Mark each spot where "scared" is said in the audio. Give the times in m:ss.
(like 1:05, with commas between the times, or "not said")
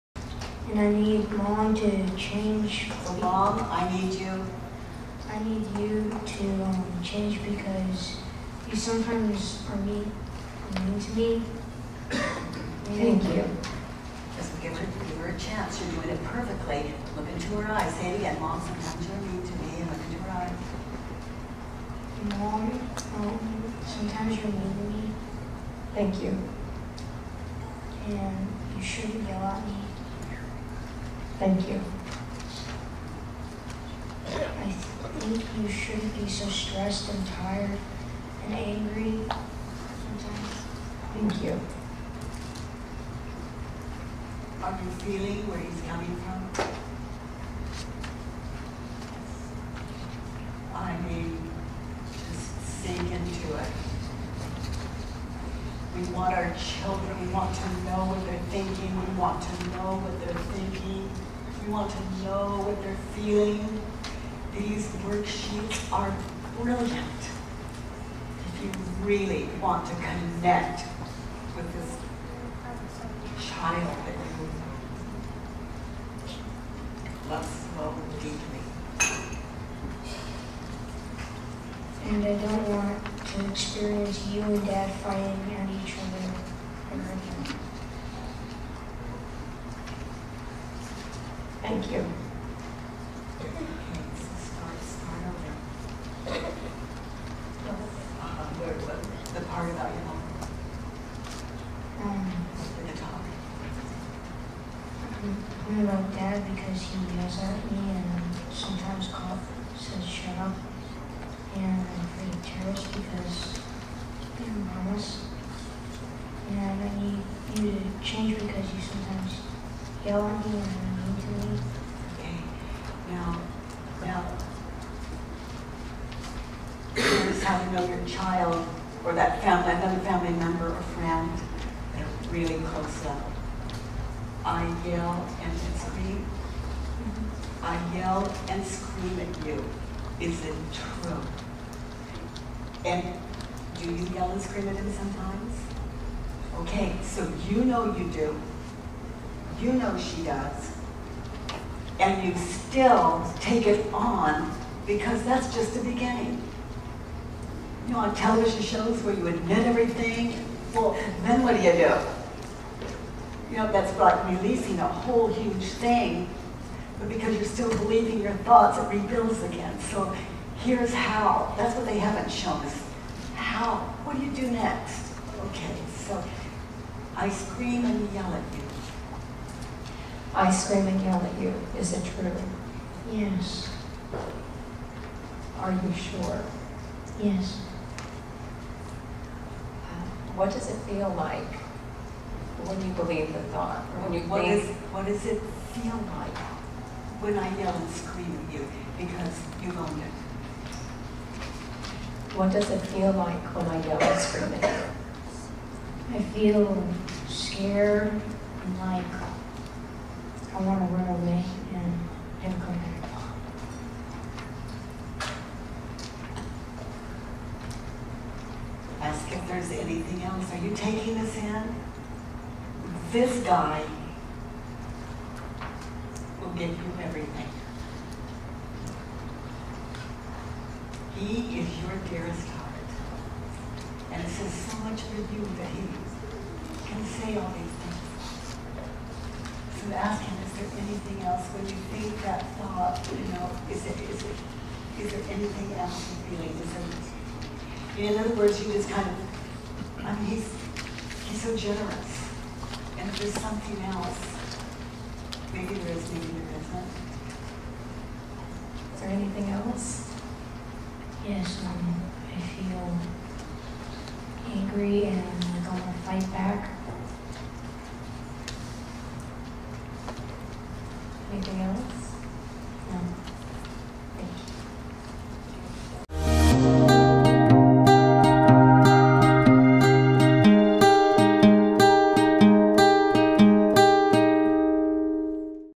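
3:27.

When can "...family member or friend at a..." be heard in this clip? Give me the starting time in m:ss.
2:10.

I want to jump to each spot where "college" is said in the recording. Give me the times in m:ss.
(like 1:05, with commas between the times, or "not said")
not said.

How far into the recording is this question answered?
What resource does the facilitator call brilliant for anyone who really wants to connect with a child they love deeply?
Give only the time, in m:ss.
1:05.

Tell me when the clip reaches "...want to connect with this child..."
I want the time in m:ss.
1:09.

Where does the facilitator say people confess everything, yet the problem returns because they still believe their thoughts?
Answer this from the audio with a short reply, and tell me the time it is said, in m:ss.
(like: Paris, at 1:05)
television shows, at 2:38.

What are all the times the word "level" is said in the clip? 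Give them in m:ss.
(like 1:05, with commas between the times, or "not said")
2:13.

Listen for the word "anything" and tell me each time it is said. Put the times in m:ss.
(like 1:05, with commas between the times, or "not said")
3:39, 4:00, 4:05, 4:19, 4:31.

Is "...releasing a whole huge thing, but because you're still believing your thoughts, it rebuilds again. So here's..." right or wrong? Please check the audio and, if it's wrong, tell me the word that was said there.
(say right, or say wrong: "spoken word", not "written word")
right.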